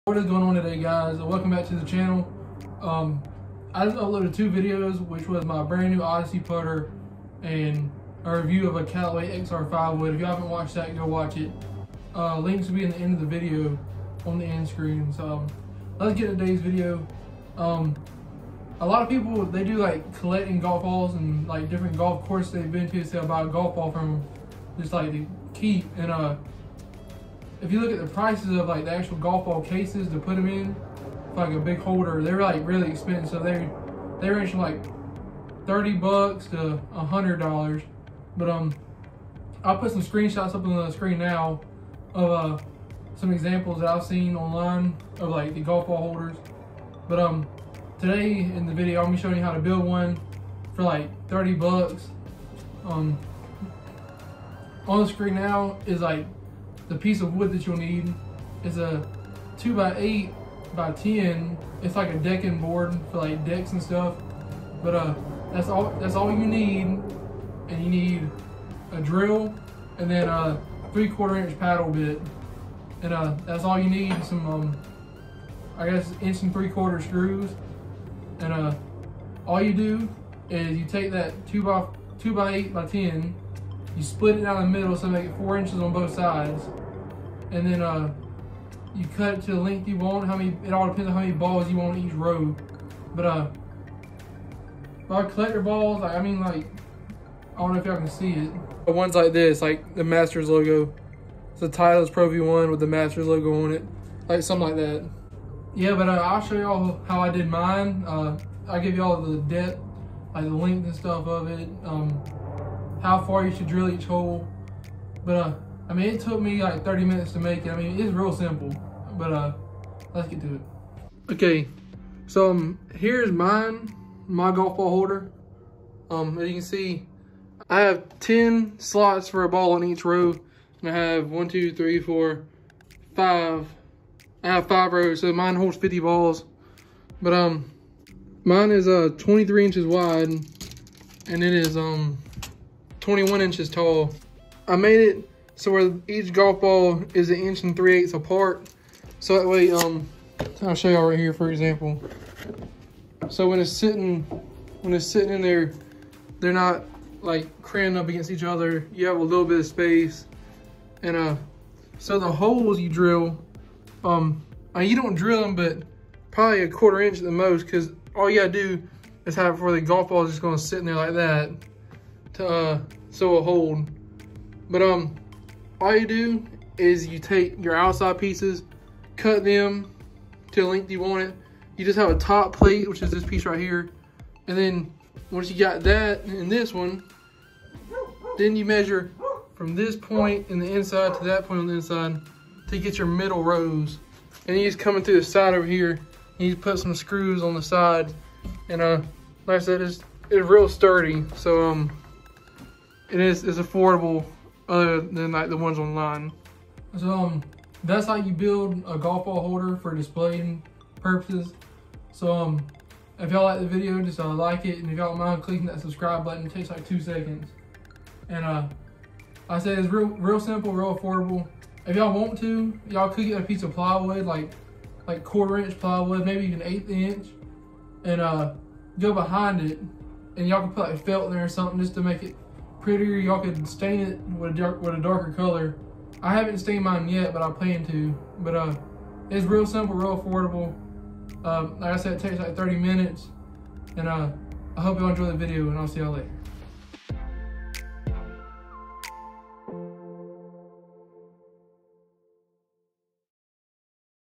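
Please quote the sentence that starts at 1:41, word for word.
It's a Titleist Pro V1 with the Masters logo on it, like something like that.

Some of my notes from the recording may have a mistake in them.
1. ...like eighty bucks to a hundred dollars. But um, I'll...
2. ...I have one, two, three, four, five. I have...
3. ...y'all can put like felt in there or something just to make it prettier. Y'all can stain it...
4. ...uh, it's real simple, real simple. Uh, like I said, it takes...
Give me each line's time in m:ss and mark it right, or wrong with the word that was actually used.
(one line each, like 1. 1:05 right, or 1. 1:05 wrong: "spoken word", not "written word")
1. 0:34 wrong: "thirty", not "eighty"
2. 2:10 right
3. 3:50 right
4. 3:58 wrong: "affordable", not "simple".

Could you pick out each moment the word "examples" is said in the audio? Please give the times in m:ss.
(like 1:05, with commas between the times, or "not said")
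0:43, 2:31.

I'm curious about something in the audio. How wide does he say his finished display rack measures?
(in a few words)
23 inches.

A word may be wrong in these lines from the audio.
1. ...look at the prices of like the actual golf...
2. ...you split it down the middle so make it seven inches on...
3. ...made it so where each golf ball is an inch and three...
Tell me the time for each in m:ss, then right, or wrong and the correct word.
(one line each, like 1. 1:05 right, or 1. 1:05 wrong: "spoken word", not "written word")
1. 0:27 right
2. 1:23 wrong: "four", not "seven"
3. 2:24 right.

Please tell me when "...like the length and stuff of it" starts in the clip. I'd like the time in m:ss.
1:50.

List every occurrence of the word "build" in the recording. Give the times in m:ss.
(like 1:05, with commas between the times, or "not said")
0:49, 3:28.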